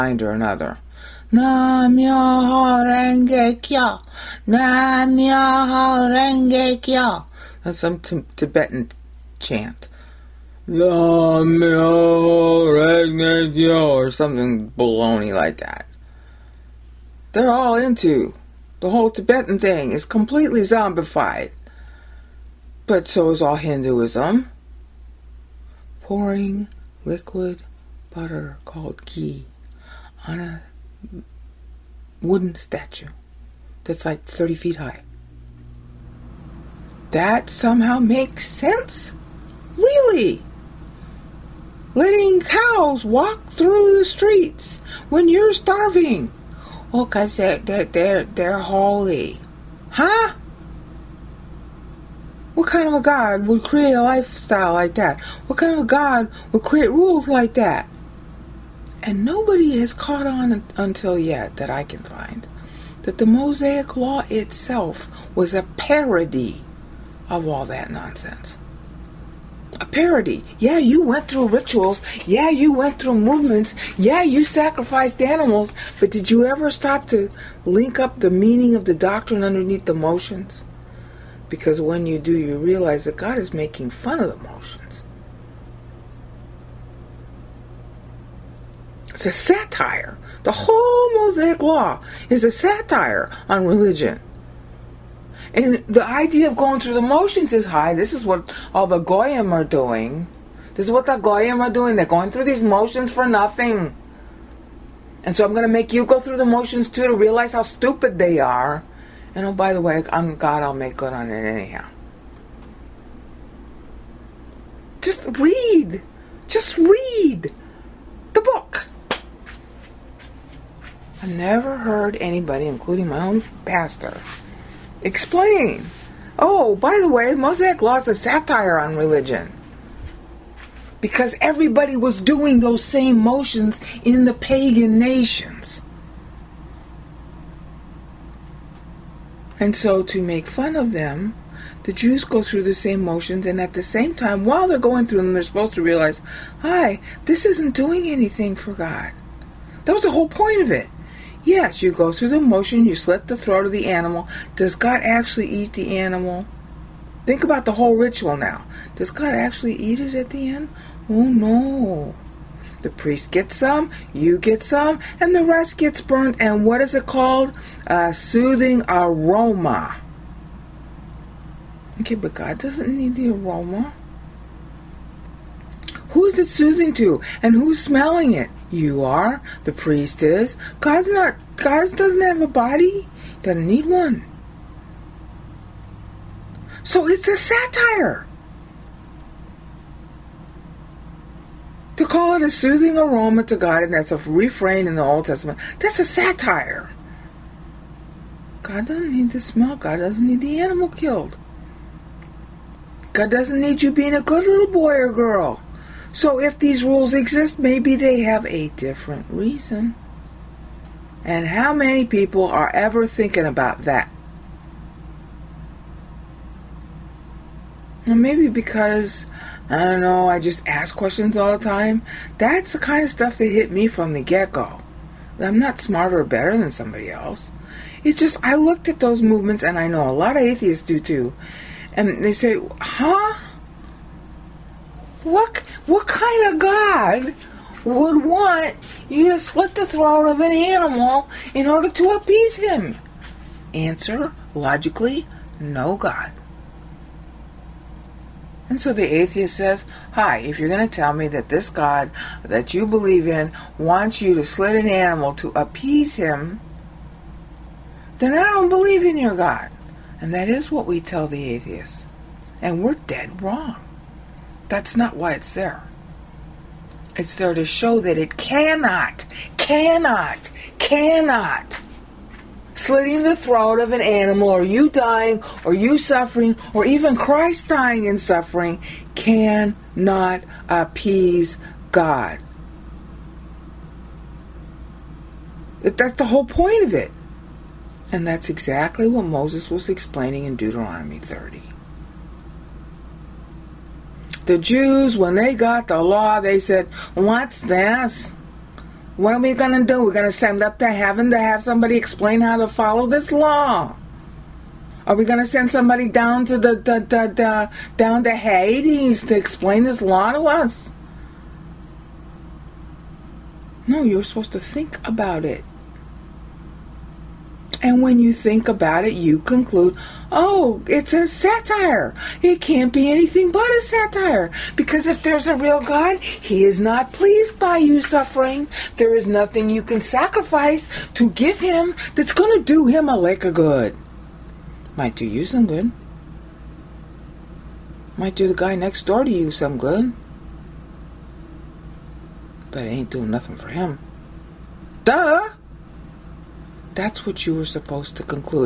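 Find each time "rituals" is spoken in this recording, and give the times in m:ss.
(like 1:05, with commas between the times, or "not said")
1:11, 2:37.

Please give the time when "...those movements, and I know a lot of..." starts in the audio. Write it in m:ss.
3:48.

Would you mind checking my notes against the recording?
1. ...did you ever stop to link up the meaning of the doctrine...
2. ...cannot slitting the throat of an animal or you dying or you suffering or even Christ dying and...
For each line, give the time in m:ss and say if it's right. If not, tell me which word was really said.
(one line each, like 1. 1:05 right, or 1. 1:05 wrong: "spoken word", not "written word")
1. 1:16 right
2. 4:30 right.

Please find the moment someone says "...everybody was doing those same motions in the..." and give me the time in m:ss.
2:11.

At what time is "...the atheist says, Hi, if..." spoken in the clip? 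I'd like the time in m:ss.
4:08.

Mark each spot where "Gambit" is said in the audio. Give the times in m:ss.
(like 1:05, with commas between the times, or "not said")
not said.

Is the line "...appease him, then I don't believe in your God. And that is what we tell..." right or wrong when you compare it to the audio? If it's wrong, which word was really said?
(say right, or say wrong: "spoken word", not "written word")
right.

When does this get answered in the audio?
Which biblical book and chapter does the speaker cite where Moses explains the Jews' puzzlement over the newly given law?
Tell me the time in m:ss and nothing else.
4:50.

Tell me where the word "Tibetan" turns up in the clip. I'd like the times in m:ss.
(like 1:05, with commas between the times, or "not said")
0:08, 0:19.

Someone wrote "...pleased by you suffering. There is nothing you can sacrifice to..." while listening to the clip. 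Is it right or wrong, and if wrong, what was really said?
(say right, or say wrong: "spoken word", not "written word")
right.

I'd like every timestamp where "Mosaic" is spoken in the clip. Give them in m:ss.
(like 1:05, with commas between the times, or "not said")
1:03, 1:31, 2:07.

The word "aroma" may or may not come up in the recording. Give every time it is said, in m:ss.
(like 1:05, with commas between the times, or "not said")
2:48, 2:53, 3:12.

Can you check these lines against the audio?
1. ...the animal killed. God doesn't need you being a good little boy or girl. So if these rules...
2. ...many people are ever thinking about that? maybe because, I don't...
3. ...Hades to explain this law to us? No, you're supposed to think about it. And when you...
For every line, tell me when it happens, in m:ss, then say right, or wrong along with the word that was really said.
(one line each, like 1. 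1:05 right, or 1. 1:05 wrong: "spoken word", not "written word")
1. 3:20 right
2. 3:31 right
3. 5:08 right.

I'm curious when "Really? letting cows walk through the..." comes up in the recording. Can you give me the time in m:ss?
0:39.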